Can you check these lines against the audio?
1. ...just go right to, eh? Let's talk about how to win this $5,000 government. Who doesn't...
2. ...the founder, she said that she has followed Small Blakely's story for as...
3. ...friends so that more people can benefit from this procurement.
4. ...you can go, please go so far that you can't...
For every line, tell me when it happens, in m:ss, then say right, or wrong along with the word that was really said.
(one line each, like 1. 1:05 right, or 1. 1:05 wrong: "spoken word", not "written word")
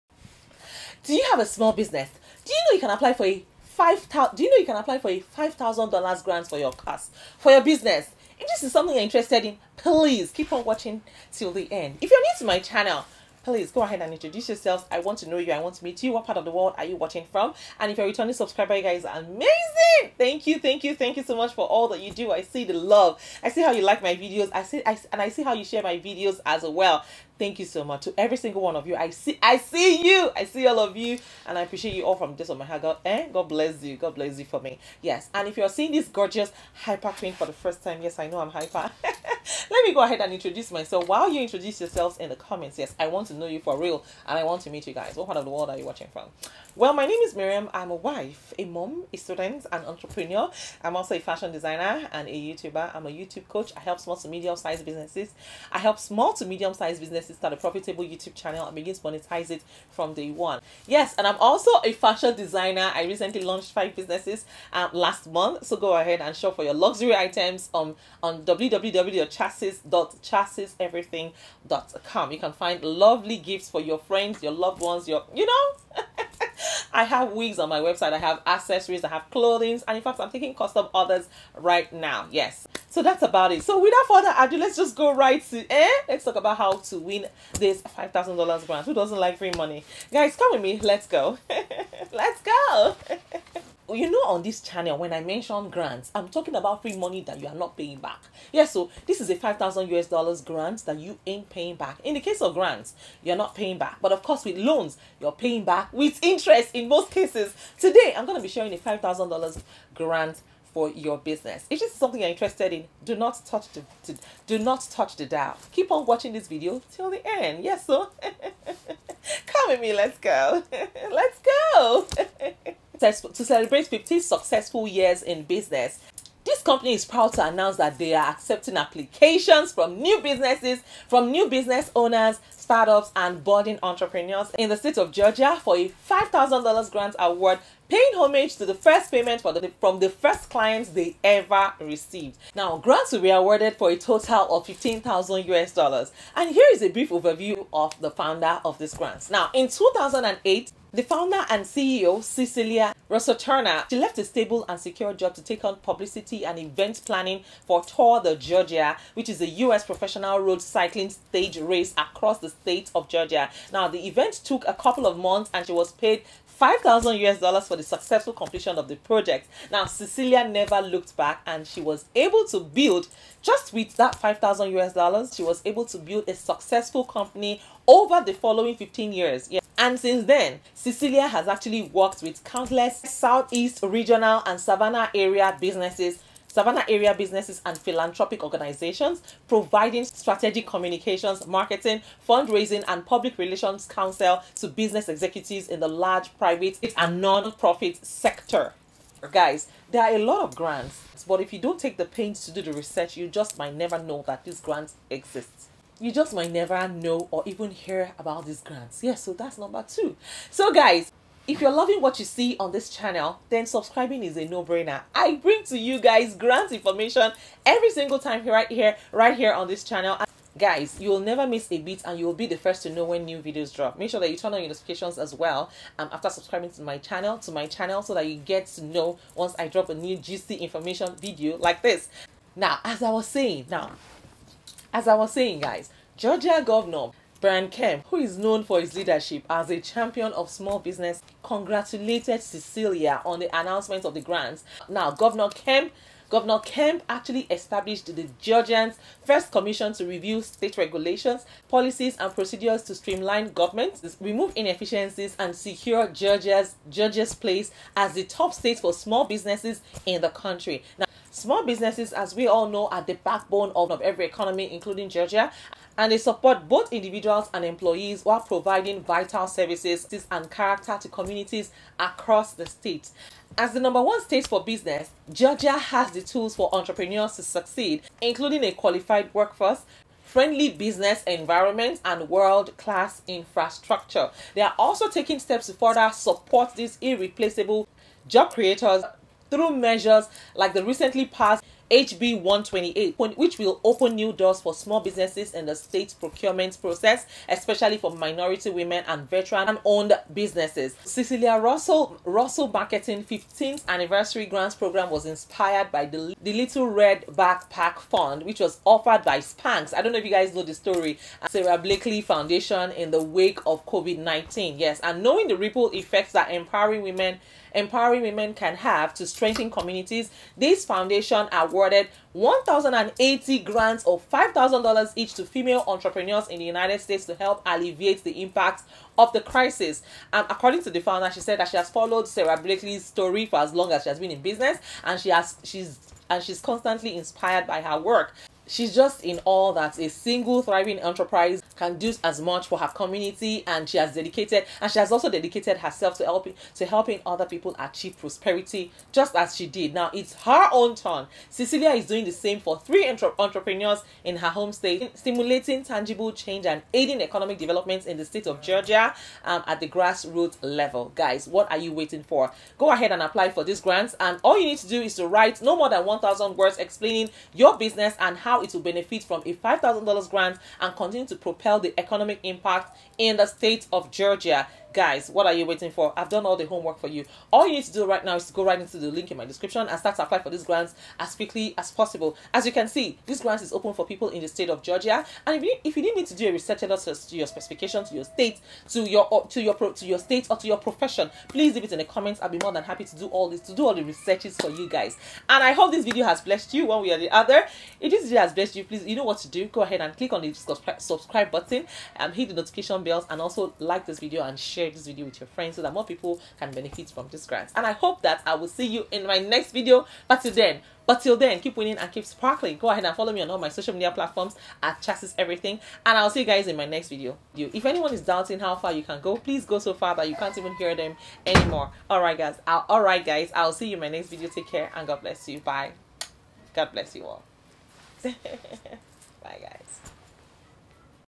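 1. 1:24 wrong: "grant", not "government"
2. 5:30 wrong: "Sara", not "Small"
3. 6:45 wrong: "grant", not "procurement"
4. 6:58 right.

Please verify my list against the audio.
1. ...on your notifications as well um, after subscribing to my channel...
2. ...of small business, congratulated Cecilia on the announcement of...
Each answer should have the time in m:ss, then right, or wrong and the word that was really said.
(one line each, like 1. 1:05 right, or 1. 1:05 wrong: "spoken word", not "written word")
1. 3:44 right
2. 4:00 right.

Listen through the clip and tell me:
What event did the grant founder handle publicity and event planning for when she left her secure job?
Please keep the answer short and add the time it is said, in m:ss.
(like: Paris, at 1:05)
Tour de Georgia, at 2:37.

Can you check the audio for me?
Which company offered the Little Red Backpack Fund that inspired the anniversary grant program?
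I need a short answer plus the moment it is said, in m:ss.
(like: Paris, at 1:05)
Spanx, at 5:09.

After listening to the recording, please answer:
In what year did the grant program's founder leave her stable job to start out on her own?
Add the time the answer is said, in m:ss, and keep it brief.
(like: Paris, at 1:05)
2008, at 2:29.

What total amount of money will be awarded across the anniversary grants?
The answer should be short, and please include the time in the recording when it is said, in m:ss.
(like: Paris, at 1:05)
$15,000, at 2:24.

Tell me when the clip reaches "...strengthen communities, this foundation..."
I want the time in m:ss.
5:19.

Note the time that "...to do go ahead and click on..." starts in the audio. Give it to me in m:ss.
6:39.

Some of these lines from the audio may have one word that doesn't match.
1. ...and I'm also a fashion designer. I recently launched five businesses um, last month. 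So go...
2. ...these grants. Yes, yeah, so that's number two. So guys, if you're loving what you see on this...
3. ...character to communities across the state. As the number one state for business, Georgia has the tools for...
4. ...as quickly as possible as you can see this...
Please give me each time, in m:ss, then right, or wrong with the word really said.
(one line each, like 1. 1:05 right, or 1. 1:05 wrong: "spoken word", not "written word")
1. 1:01 right
2. 3:28 right
3. 4:30 right
4. 6:21 right.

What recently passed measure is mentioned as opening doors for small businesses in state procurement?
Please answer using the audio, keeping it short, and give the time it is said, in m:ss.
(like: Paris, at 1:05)
HB 128, at 4:51.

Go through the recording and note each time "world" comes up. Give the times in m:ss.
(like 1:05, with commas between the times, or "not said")
0:16, 0:45, 4:42.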